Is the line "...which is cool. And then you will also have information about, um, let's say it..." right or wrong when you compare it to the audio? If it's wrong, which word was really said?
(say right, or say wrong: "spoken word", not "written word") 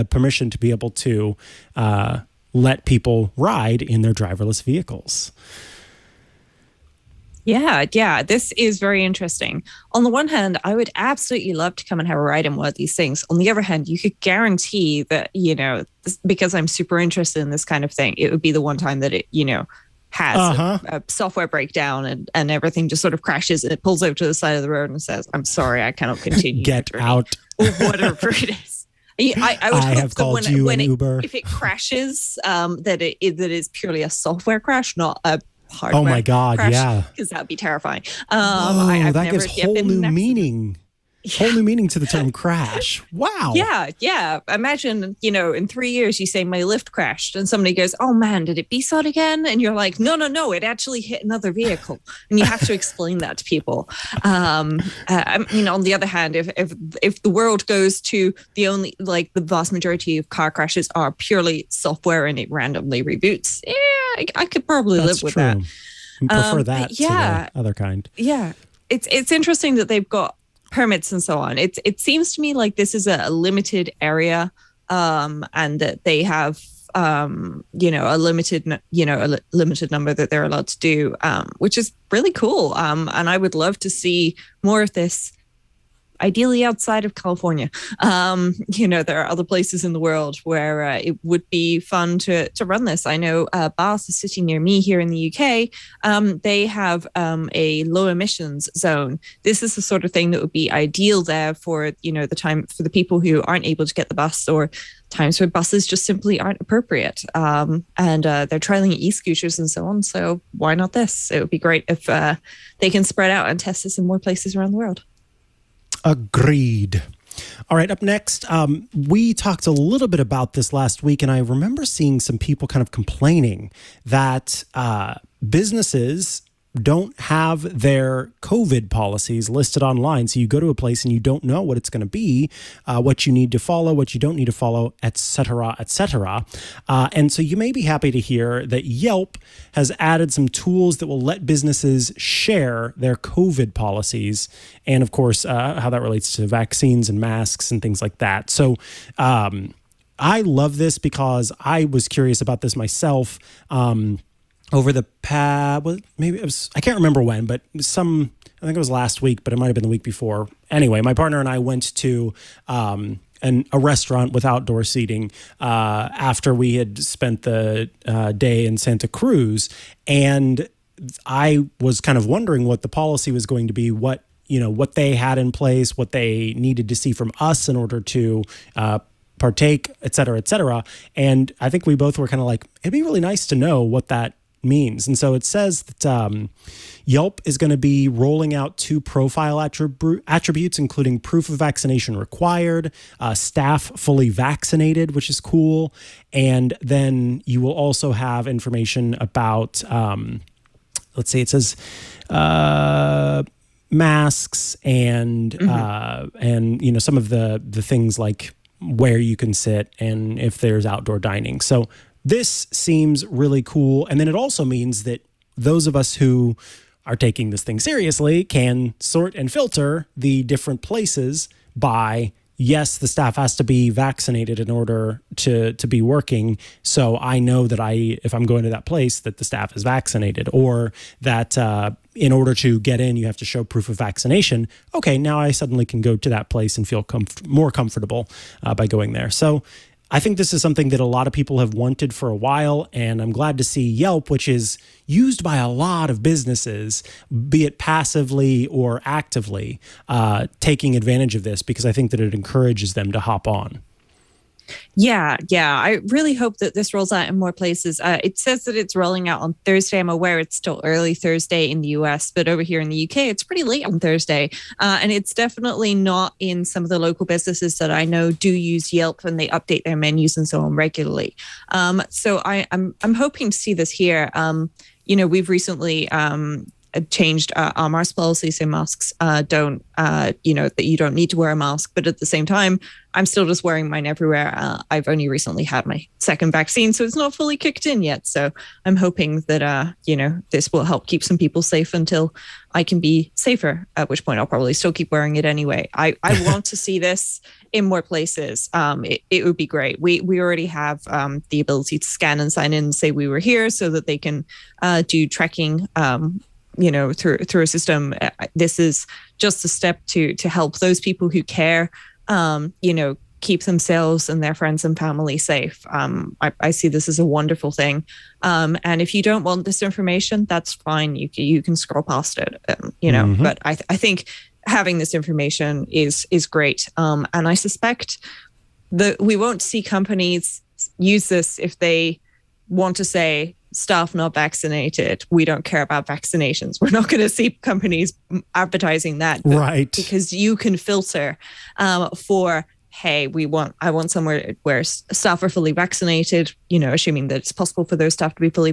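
right.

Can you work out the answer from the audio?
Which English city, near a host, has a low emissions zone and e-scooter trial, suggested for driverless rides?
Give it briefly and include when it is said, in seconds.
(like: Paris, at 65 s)
Bath, at 93 s.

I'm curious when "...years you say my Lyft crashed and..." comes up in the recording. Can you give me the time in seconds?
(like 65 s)
45 s.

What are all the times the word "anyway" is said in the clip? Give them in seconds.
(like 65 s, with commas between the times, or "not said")
160 s, 295 s.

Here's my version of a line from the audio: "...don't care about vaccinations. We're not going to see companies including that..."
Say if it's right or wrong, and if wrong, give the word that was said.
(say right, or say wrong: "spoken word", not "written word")
wrong: "advertising", not "including".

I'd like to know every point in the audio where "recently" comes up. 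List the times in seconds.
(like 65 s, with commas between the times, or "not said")
275 s, 285 s.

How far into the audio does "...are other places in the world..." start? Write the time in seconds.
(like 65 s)
89 s.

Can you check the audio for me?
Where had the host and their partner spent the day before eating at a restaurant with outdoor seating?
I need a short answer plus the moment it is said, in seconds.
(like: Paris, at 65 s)
Santa Cruz, at 168 s.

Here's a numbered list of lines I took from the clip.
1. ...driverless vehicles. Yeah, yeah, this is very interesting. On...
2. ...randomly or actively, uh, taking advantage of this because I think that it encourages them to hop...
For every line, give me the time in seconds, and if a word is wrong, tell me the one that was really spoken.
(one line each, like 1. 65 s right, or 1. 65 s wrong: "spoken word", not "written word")
1. 4 s right
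2. 247 s wrong: "passively", not "randomly".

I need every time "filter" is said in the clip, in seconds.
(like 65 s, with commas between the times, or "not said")
219 s, 340 s.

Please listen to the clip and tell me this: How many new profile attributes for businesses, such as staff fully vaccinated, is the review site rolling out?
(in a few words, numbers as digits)
2.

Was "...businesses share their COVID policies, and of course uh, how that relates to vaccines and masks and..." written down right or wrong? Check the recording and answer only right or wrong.
right.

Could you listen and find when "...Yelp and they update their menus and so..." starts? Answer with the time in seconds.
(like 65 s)
268 s.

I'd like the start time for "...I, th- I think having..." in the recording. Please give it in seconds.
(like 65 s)
323 s.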